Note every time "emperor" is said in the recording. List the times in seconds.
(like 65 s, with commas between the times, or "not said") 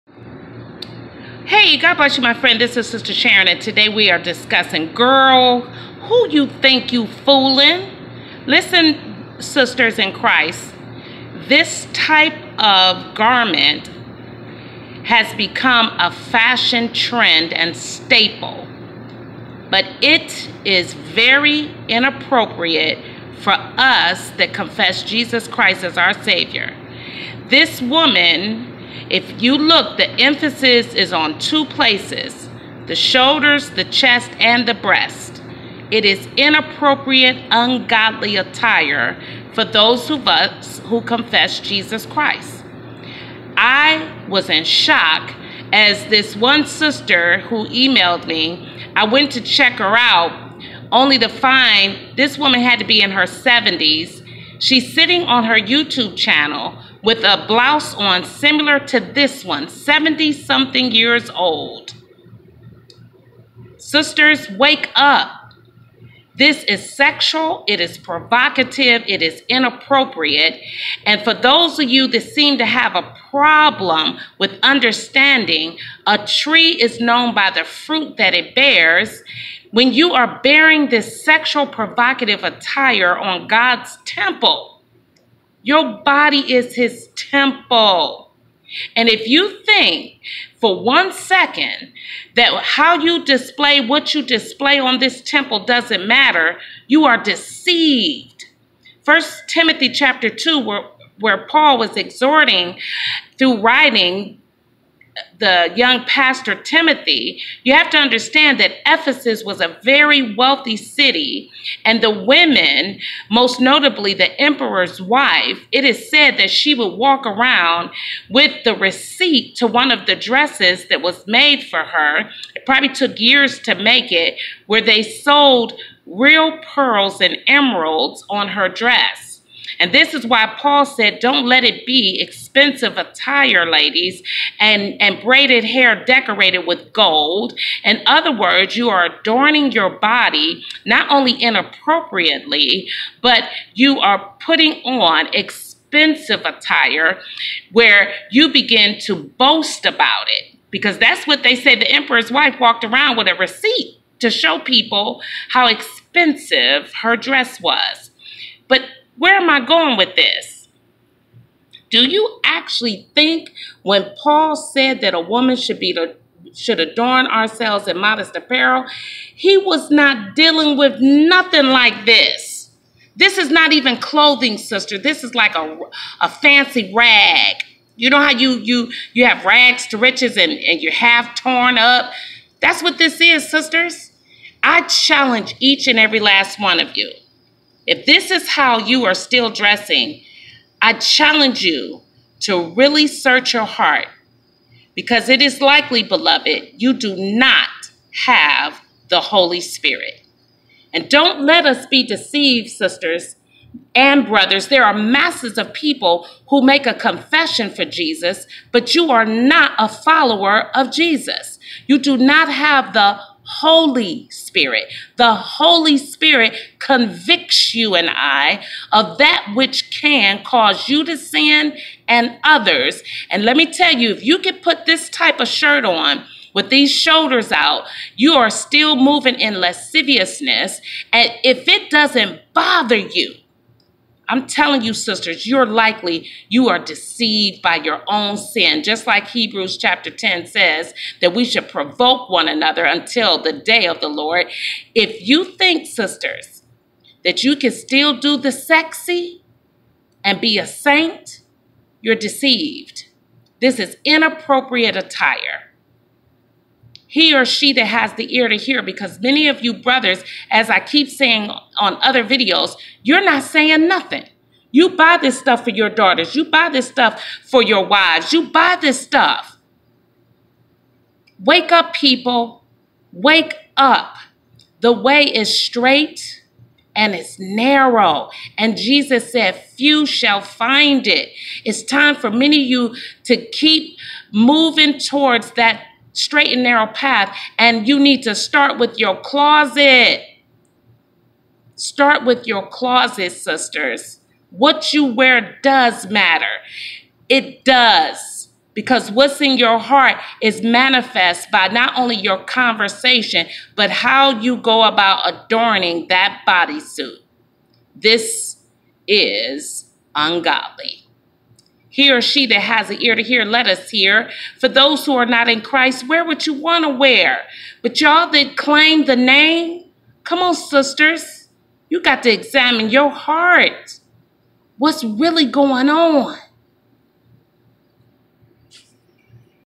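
114 s, 151 s.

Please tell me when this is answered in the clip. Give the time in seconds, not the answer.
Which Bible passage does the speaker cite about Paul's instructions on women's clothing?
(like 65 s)
99 s.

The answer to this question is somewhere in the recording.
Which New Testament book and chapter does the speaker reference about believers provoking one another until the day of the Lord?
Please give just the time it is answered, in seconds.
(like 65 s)
239 s.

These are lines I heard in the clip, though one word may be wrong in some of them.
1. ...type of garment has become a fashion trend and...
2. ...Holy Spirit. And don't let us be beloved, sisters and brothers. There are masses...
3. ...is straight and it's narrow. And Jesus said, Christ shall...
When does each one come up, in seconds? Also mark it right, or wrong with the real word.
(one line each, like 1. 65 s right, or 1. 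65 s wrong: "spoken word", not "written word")
1. 11 s right
2. 199 s wrong: "deceived", not "beloved"
3. 275 s wrong: "Few", not "Christ".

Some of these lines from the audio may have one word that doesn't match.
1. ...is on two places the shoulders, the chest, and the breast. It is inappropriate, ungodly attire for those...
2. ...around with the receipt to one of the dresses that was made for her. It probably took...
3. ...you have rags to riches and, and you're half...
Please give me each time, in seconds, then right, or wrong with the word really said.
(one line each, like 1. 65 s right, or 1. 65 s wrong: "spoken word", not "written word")
1. 30 s right
2. 117 s right
3. 179 s right.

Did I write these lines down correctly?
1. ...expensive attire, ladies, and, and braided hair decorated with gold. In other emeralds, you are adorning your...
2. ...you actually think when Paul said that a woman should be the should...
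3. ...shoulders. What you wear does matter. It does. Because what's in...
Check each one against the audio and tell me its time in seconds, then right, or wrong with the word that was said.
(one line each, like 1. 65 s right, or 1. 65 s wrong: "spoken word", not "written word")
1. 132 s wrong: "words", not "emeralds"
2. 162 s right
3. 293 s wrong: "sisters", not "shoulders".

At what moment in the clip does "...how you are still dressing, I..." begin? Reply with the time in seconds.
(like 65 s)
188 s.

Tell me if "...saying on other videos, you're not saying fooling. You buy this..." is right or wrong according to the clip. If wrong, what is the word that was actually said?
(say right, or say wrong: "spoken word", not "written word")
wrong: "nothing", not "fooling".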